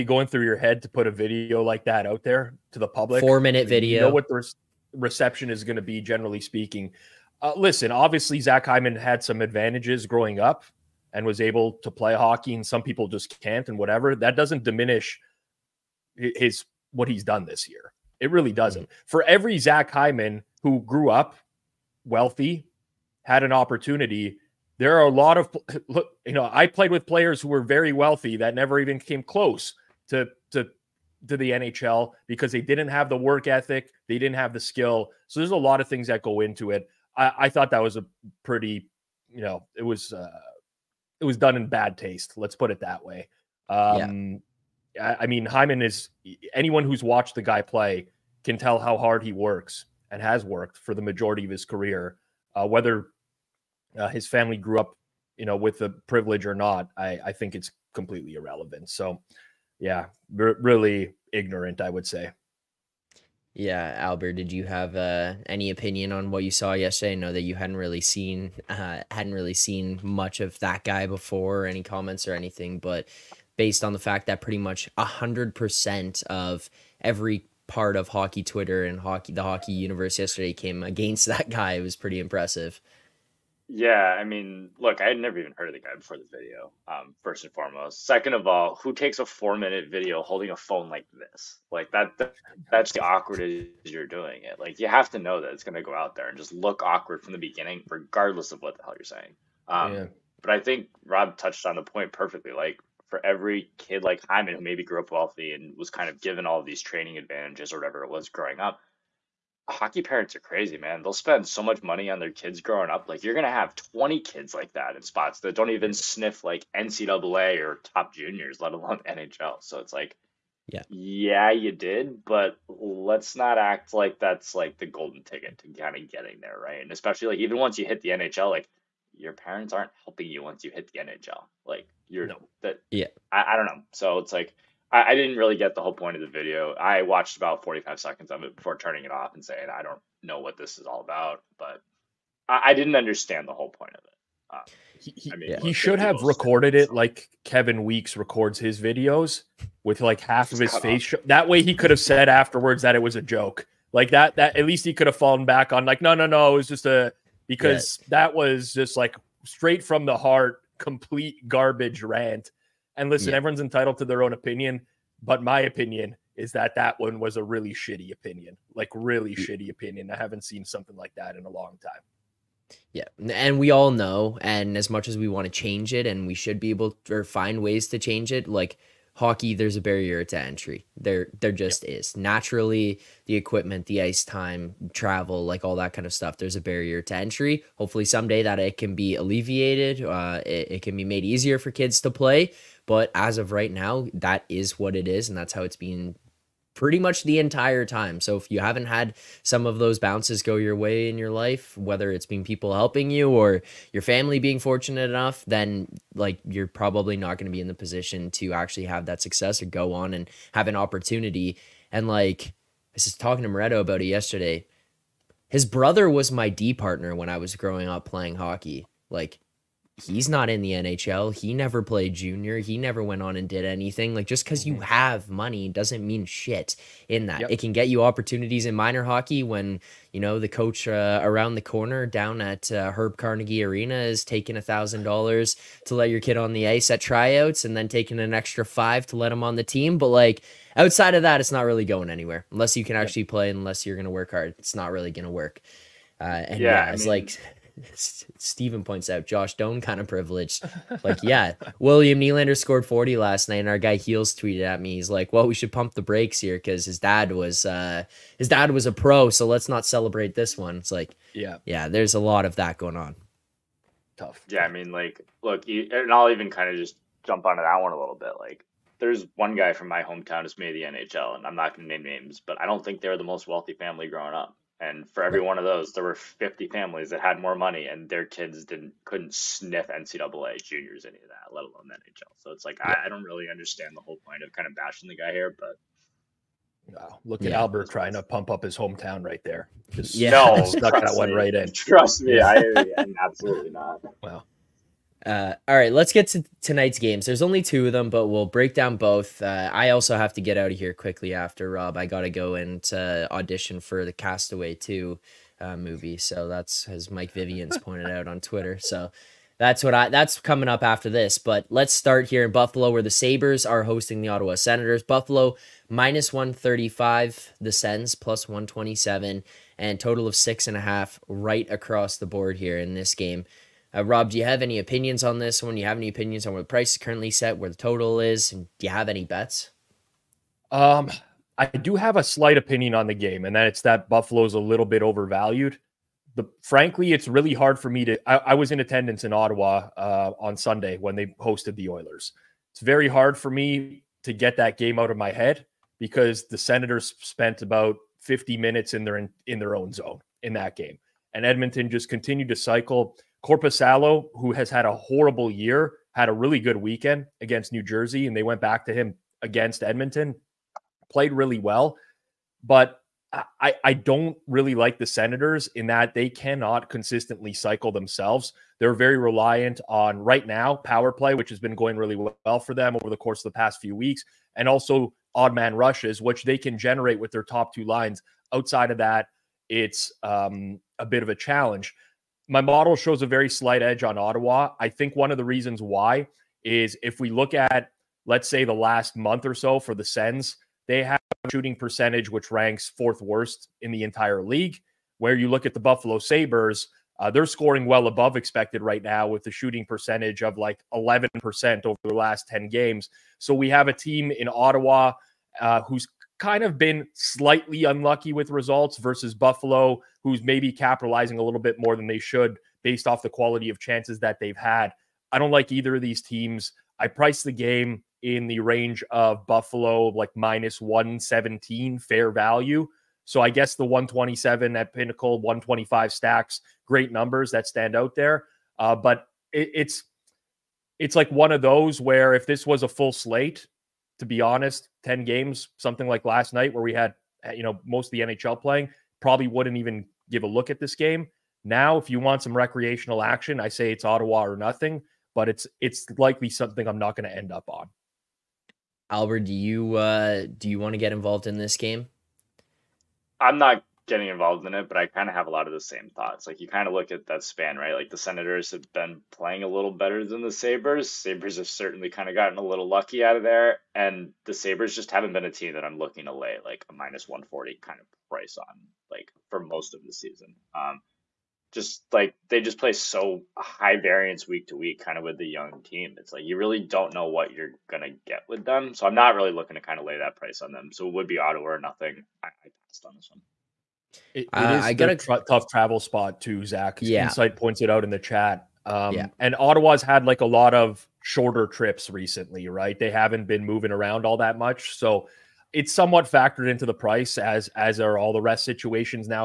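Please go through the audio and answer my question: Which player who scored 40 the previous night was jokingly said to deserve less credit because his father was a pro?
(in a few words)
William Nylander.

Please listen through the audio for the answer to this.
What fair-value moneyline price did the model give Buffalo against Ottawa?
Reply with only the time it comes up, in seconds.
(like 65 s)
420 s.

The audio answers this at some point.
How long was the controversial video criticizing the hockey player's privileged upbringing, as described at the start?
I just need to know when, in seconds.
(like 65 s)
3 s.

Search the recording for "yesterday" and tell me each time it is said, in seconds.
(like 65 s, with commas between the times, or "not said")
66 s, 80 s, 214 s.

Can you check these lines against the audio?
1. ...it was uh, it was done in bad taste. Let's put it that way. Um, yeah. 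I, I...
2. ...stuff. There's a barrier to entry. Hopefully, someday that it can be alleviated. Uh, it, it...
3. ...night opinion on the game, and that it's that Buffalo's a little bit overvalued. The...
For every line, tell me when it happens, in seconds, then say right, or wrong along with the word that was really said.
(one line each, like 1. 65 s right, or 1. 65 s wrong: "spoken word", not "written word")
1. 39 s right
2. 186 s right
3. 332 s wrong: "slight", not "night".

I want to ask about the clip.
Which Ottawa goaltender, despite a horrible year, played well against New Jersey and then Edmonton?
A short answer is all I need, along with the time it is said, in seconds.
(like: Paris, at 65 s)
Korpisalo, at 353 s.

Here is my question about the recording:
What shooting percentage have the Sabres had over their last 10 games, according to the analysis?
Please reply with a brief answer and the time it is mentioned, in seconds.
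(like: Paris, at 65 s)
11%, at 400 s.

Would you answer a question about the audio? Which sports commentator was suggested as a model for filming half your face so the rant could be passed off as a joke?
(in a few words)
Kevin Weeks.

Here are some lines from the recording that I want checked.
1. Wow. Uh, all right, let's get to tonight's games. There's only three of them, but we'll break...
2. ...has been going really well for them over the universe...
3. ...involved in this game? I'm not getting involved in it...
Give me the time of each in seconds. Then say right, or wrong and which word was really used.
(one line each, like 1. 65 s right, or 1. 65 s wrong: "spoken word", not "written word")
1. 294 s wrong: "two", not "three"
2. 371 s wrong: "course", not "universe"
3. 451 s right.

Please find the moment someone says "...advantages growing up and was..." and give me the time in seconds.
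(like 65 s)
9 s.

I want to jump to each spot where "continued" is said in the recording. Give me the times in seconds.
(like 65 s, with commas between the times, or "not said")
352 s.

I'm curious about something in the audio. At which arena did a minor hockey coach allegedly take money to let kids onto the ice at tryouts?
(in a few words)
Herb Carnegie Arena.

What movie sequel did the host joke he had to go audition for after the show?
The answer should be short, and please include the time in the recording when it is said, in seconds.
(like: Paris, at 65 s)
Castaway 2, at 304 s.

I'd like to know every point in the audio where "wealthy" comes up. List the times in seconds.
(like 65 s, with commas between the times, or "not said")
22 s, 27 s, 105 s, 273 s.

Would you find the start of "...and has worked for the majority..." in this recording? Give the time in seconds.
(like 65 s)
50 s.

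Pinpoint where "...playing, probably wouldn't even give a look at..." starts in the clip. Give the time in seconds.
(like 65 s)
438 s.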